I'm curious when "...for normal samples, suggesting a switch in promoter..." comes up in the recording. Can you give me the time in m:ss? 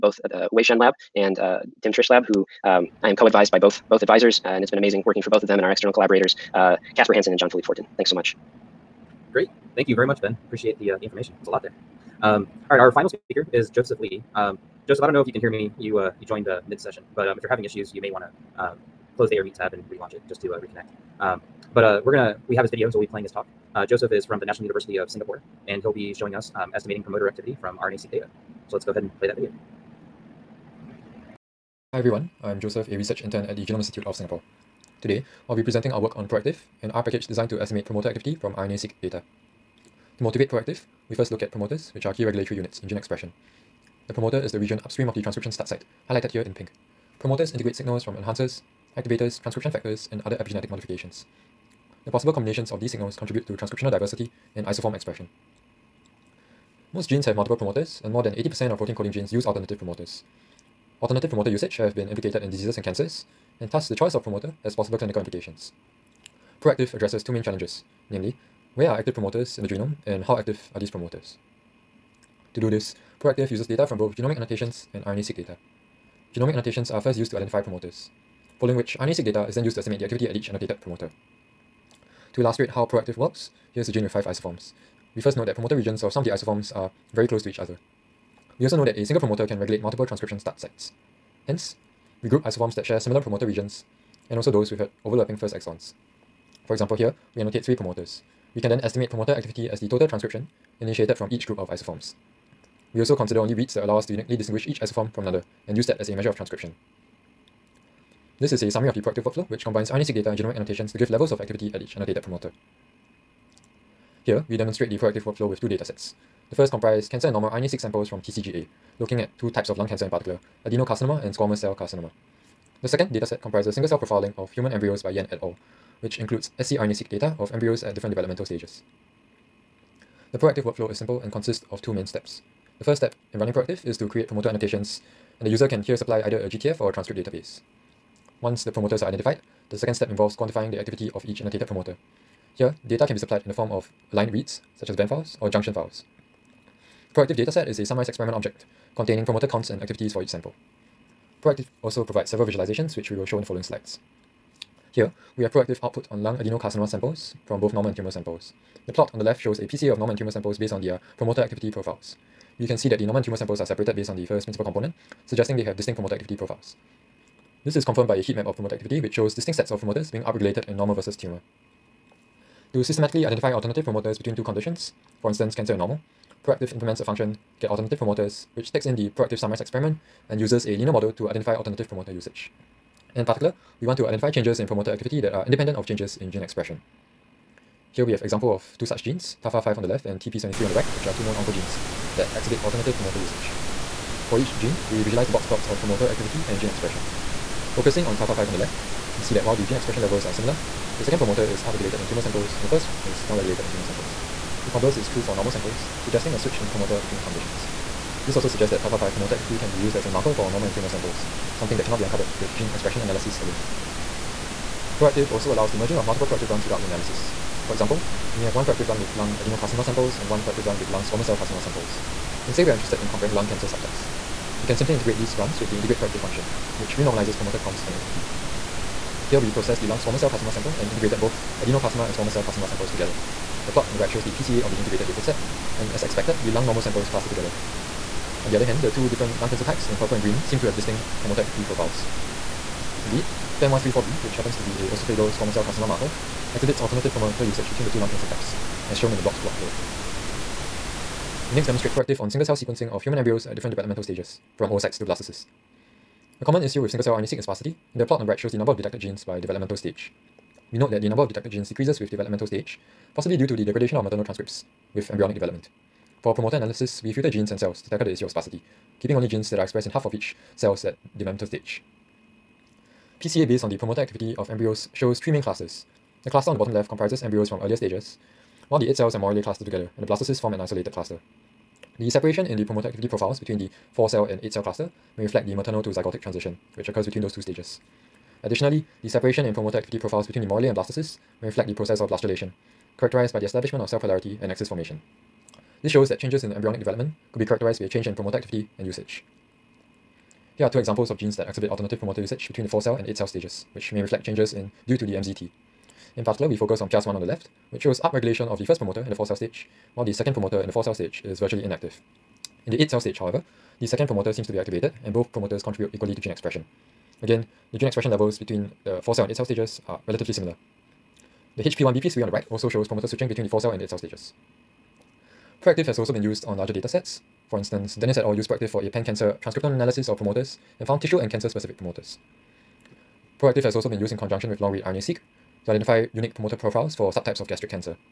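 3:25.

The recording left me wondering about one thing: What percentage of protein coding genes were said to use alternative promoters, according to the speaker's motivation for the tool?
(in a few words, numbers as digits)
More than 80%.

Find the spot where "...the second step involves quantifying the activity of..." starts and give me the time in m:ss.
2:19.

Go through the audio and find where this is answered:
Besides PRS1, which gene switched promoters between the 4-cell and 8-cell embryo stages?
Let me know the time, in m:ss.
5:21.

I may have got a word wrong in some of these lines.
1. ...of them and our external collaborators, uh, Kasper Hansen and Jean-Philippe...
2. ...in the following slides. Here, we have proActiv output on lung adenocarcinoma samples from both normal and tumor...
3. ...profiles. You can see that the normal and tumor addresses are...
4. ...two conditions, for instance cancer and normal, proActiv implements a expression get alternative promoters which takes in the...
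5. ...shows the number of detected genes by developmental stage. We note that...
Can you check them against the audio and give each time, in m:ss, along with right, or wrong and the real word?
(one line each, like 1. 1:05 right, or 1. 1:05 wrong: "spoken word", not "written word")
1. 0:05 right
2. 2:33 right
3. 2:41 wrong: "samples", not "addresses"
4. 2:54 wrong: "function", not "expression"
5. 4:18 right.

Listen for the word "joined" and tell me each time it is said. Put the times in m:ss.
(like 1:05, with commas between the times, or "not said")
0:16.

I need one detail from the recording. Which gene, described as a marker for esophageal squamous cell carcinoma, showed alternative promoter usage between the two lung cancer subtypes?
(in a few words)
FAM134B.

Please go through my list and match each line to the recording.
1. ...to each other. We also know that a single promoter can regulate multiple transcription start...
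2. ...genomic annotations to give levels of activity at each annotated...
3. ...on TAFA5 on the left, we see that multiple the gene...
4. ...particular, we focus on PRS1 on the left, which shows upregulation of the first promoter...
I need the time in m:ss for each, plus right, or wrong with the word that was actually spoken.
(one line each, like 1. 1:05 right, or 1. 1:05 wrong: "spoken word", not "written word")
1. 1:27 right
2. 1:50 right
3. 3:18 wrong: "while", not "multiple"
4. 5:06 right.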